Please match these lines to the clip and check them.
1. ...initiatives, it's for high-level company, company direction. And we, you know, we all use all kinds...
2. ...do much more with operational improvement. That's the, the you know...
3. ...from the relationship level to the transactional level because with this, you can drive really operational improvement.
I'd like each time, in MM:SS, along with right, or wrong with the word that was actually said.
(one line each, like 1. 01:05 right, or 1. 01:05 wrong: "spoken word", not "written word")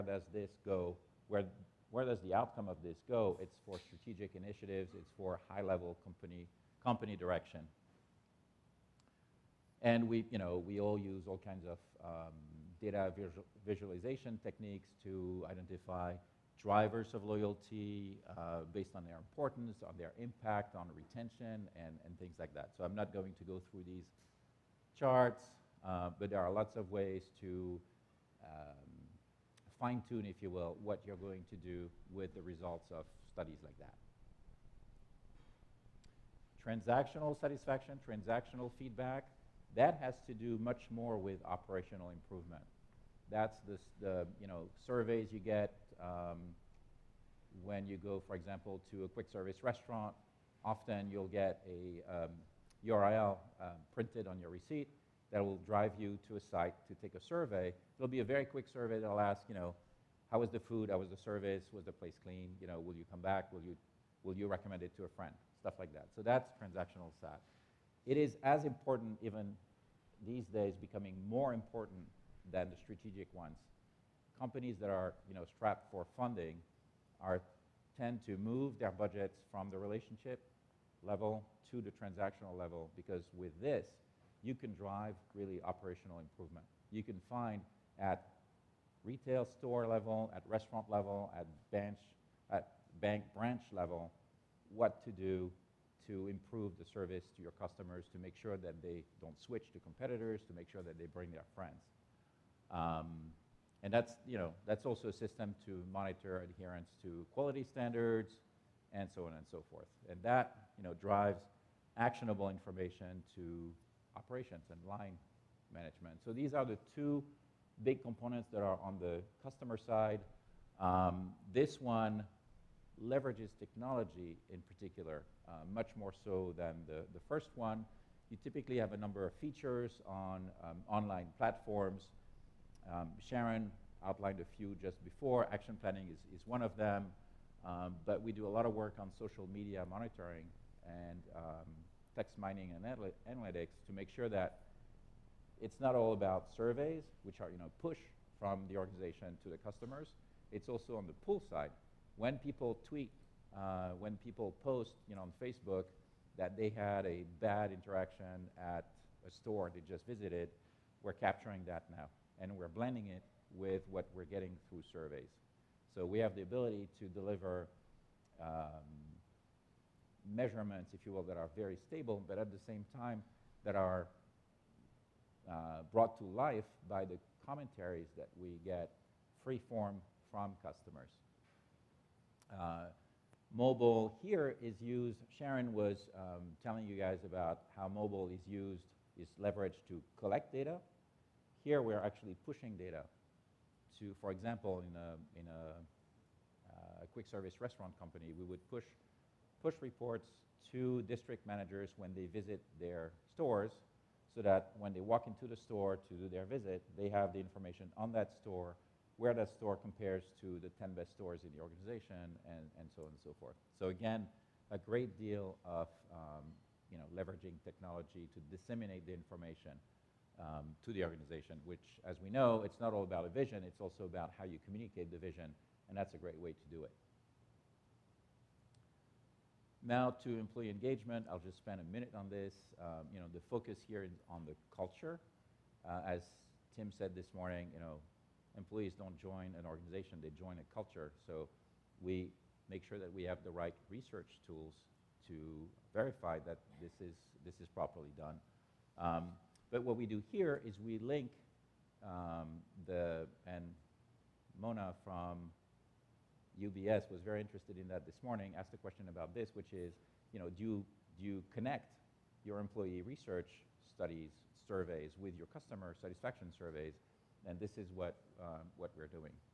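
1. 00:04 right
2. 00:40 right
3. 01:19 right.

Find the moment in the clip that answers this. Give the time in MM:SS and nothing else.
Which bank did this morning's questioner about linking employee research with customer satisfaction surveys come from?
04:16.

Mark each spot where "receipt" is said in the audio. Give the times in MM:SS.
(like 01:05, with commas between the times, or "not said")
00:54.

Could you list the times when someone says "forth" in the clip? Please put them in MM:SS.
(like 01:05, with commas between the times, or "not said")
01:49, 03:33.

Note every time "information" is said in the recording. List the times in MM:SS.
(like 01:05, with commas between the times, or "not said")
01:52, 03:27, 03:39.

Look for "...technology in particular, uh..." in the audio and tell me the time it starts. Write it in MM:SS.
02:03.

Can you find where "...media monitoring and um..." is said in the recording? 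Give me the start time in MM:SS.
02:19.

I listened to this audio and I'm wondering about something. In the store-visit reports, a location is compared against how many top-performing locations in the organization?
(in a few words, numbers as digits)
10.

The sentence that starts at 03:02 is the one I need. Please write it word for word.
Uh, mobile here is used, Sharon was um, telling you guys about how mobile is used, is leveraged to collect data.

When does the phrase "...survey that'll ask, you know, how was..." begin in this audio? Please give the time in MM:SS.
00:58.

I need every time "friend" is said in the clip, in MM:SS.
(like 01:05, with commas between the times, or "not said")
01:05, 01:41.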